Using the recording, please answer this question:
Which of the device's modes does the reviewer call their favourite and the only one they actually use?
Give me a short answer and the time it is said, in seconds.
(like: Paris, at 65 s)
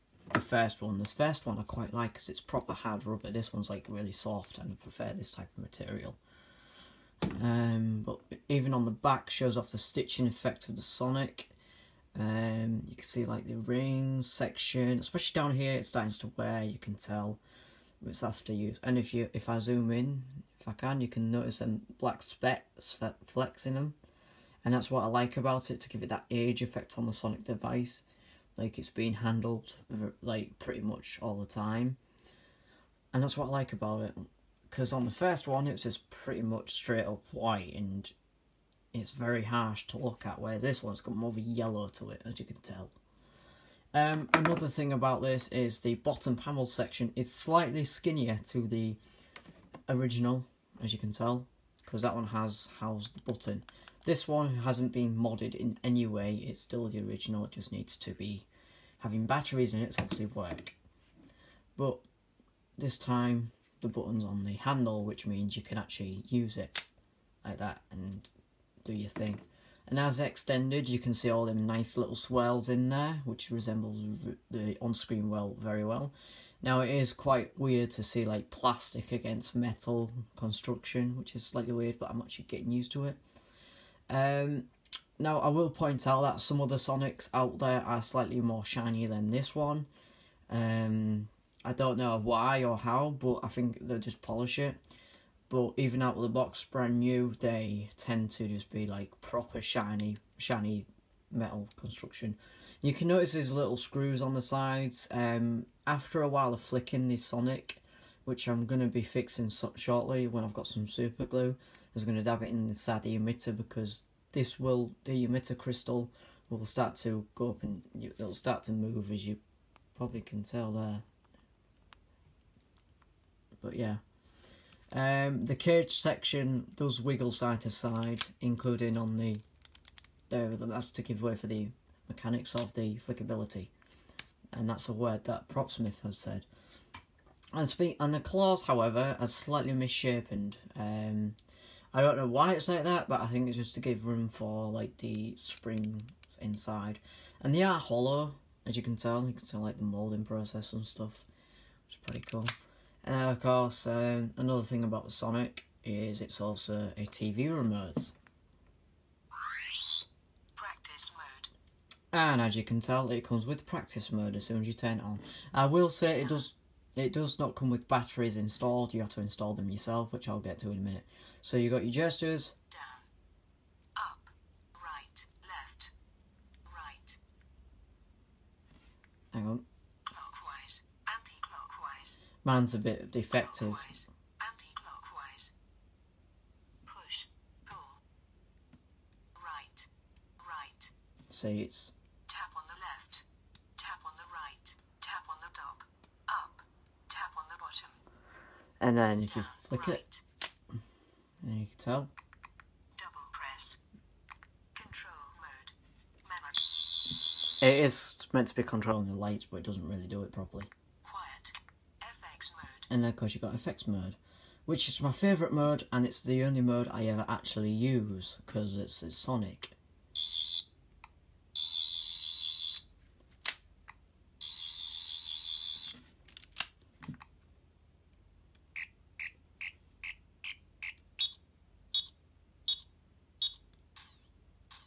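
effects mode, at 213 s.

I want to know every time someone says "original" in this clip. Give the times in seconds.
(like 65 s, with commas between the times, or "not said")
49 s, 57 s.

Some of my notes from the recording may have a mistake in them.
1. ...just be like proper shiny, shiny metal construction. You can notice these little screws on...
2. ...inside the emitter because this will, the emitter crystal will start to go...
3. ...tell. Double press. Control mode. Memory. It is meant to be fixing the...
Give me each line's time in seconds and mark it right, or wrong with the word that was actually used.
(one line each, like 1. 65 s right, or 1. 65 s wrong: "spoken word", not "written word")
1. 98 s right
2. 112 s right
3. 201 s wrong: "controlling", not "fixing".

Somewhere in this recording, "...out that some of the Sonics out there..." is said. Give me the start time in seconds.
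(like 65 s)
86 s.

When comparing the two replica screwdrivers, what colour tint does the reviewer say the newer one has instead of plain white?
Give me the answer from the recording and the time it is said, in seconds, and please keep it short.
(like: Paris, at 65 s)
yellow, at 41 s.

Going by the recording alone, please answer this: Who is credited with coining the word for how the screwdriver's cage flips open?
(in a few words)
Propsmith.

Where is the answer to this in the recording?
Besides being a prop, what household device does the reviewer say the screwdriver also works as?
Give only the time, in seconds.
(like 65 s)
157 s.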